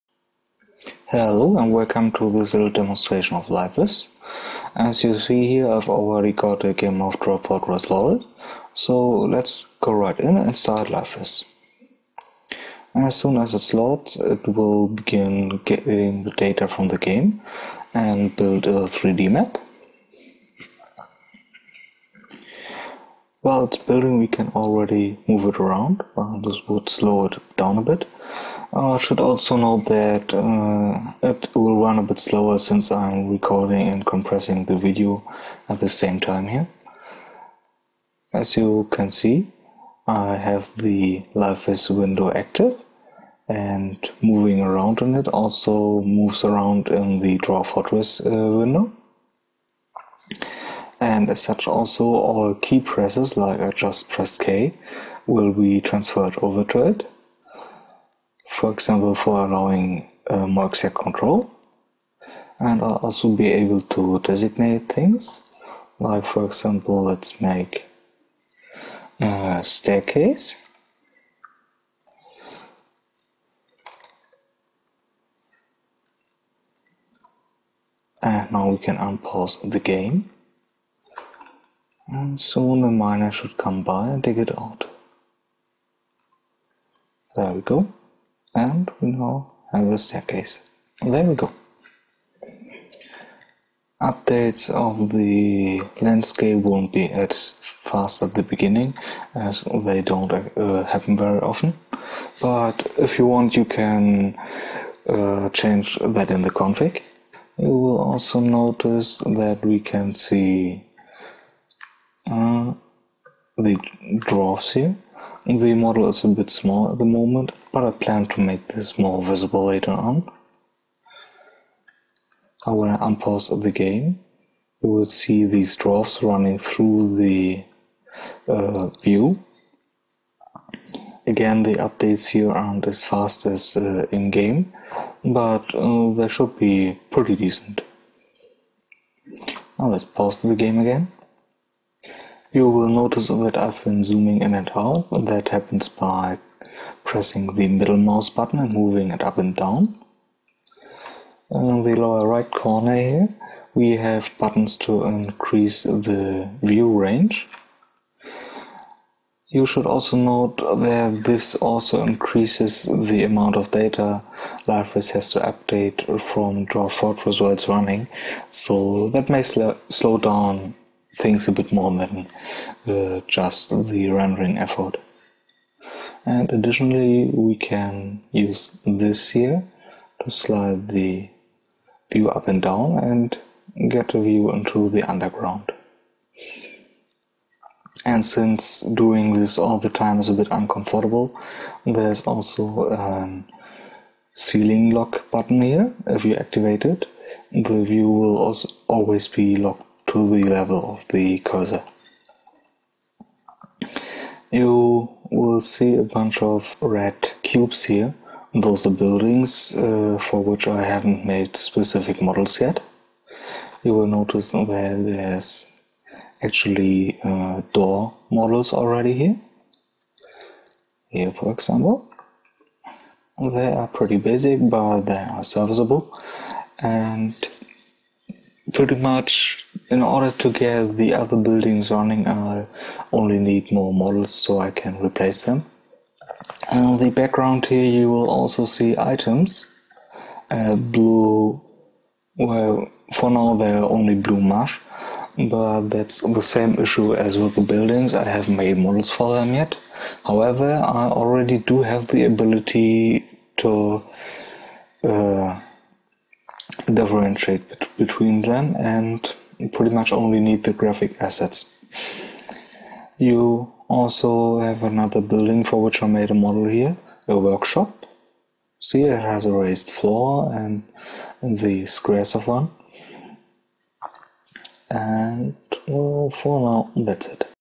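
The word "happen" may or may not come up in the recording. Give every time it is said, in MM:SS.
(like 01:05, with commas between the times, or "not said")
01:40, 02:25.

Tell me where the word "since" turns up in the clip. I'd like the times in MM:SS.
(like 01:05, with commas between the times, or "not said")
00:32, 03:08.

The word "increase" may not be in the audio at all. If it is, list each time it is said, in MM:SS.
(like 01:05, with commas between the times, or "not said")
02:35, 02:42.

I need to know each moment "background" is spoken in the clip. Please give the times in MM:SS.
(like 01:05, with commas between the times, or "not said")
03:57.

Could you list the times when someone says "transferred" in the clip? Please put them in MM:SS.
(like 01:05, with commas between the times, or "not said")
00:55.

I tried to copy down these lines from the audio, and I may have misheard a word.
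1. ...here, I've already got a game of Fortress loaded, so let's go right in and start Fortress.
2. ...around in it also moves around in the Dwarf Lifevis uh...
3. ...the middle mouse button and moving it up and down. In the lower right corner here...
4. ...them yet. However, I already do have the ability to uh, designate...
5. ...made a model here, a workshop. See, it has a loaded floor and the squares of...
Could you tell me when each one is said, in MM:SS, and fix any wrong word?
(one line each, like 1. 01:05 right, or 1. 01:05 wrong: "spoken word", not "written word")
1. 00:05 wrong: "Lifevis", not "Fortress"
2. 00:44 wrong: "Fortress", not "Lifevis"
3. 02:27 right
4. 04:09 wrong: "differentiate", not "designate"
5. 04:26 wrong: "raised", not "loaded".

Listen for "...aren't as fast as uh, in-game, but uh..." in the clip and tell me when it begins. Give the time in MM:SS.
02:12.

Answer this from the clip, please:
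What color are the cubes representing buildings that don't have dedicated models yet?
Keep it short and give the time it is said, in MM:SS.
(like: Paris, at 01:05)
red, at 03:26.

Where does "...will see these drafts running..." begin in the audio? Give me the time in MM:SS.
02:04.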